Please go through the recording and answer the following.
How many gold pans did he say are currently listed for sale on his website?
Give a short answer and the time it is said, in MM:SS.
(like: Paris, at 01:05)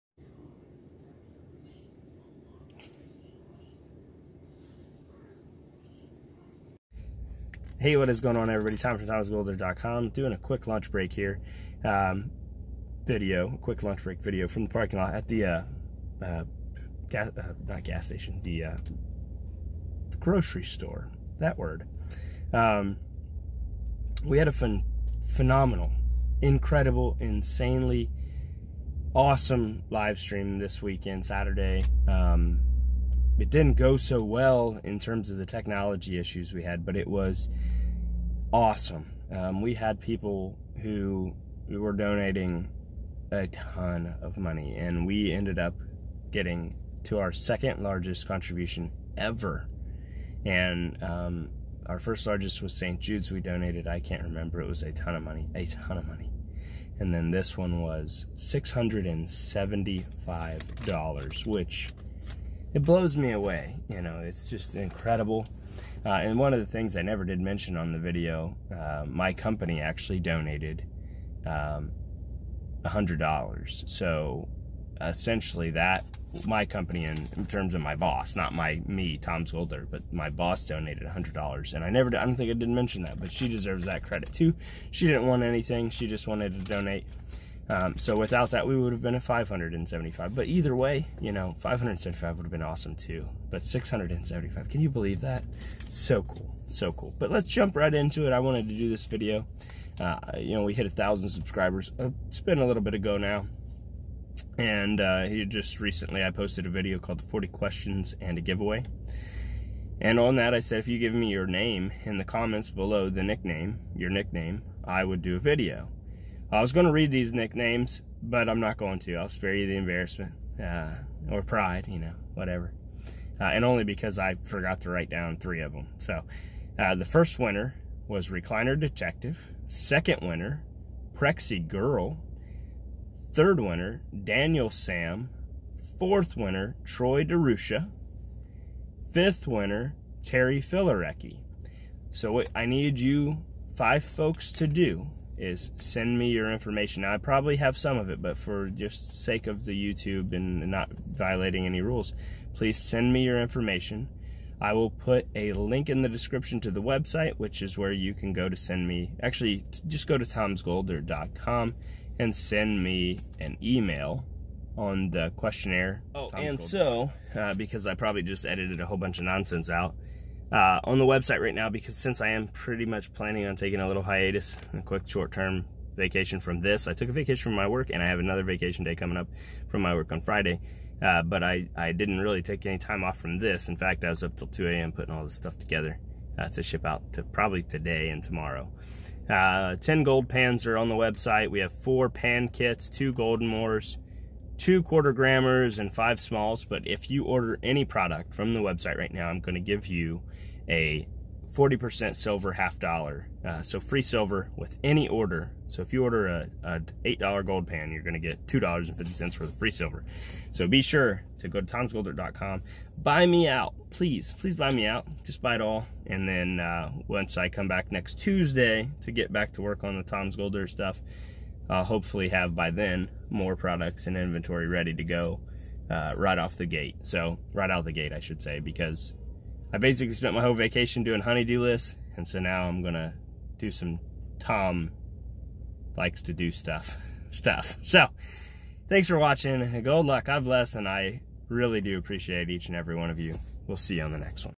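10, at 03:09.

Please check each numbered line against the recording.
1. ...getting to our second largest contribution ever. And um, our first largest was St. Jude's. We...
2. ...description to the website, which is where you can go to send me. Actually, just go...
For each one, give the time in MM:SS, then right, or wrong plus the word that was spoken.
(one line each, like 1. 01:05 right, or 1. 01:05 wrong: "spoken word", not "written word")
1. 00:46 right
2. 02:36 right.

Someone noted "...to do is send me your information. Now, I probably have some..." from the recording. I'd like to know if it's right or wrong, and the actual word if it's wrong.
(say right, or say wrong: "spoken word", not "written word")
right.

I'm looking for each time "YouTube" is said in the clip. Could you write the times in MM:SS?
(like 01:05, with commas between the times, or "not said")
02:29.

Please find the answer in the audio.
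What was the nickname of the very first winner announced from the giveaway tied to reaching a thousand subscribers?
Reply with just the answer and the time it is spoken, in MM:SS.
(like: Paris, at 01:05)
Recliner Detective, at 02:08.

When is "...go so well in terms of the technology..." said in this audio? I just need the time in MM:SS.
00:33.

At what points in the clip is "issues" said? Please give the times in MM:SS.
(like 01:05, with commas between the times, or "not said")
00:36.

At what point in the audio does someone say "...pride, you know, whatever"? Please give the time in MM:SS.
02:01.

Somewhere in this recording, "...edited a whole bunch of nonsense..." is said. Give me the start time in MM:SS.
02:48.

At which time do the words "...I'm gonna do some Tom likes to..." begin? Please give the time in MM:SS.
03:52.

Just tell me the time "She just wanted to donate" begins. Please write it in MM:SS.
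01:25.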